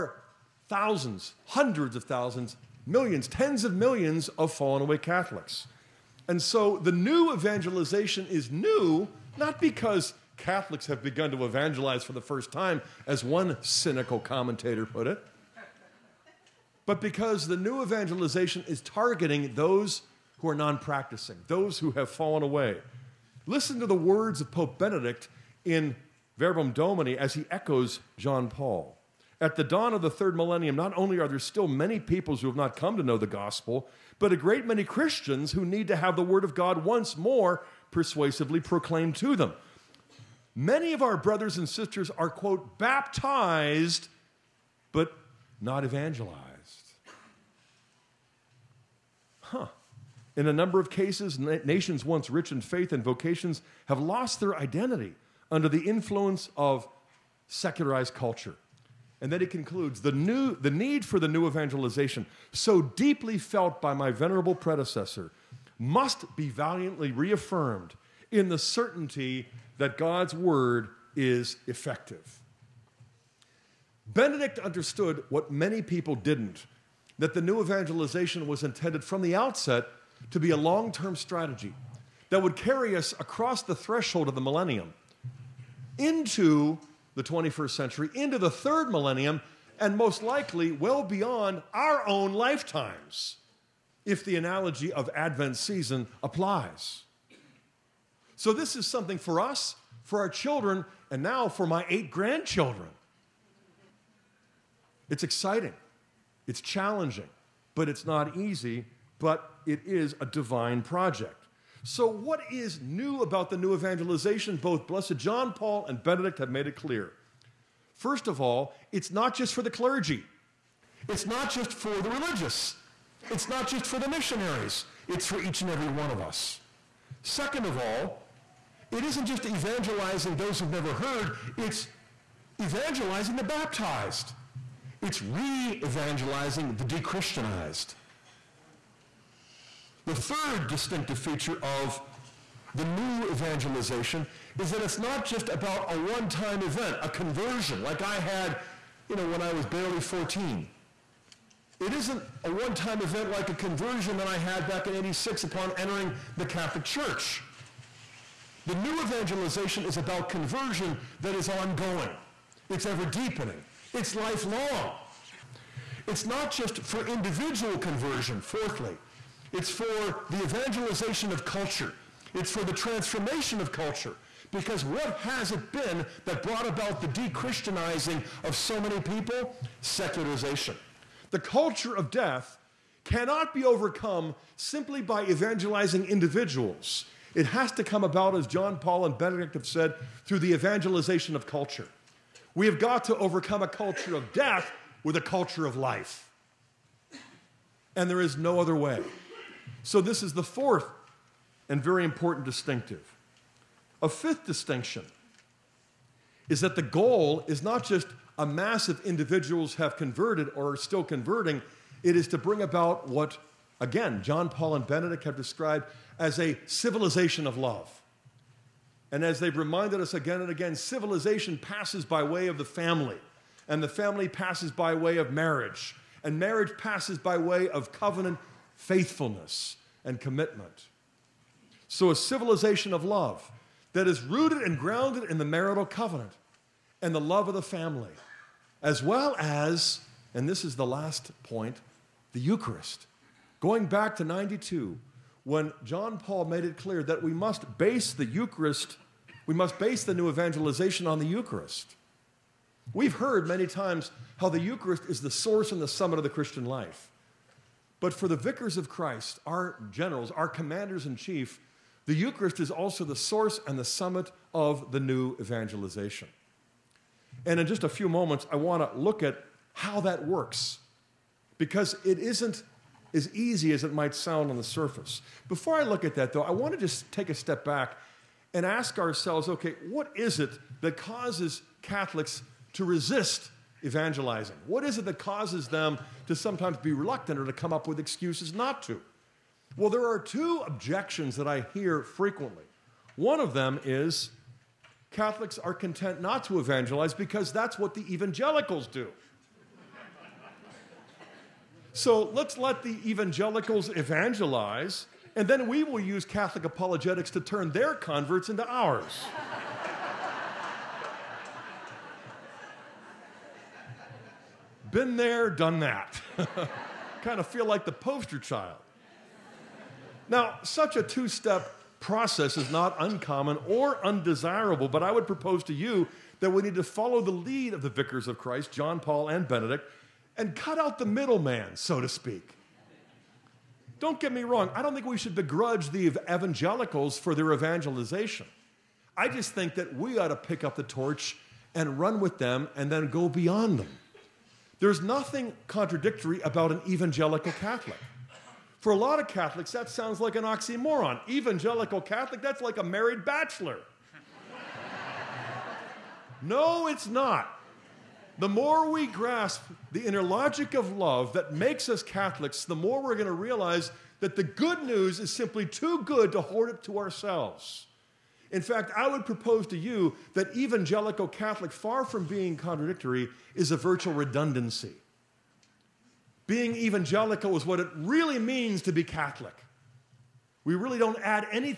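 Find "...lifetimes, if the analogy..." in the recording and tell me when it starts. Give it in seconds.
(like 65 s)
92 s.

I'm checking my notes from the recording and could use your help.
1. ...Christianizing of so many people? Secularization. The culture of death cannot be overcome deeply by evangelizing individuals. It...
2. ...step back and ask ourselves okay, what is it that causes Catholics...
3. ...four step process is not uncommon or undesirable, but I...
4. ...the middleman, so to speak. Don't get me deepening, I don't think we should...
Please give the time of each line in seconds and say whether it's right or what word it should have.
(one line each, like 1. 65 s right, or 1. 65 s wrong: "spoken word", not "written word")
1. 177 s wrong: "simply", not "deeply"
2. 277 s right
3. 321 s wrong: "two", not "four"
4. 330 s wrong: "wrong", not "deepening".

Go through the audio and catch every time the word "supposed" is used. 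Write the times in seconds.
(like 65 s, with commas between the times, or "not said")
not said.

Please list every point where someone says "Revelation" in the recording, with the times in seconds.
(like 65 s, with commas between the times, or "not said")
not said.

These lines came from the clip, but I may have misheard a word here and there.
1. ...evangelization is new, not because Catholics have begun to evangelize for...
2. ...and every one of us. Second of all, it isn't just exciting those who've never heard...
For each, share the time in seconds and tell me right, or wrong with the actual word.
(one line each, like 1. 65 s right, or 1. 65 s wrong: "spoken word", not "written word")
1. 7 s right
2. 125 s wrong: "evangelizing", not "exciting".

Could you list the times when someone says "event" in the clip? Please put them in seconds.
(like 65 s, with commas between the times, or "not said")
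146 s, 153 s.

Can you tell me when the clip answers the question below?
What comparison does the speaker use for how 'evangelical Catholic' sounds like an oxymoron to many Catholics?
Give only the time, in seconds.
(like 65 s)
352 s.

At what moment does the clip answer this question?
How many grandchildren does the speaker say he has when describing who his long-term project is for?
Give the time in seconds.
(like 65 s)
101 s.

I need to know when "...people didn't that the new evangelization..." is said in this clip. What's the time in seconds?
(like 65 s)
75 s.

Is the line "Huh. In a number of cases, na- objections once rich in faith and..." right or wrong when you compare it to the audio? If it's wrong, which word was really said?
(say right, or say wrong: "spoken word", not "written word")
wrong: "nations", not "objections".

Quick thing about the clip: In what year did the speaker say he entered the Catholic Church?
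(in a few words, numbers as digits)
1986.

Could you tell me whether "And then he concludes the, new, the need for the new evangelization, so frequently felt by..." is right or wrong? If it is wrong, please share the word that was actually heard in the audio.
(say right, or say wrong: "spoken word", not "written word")
wrong: "deeply", not "frequently".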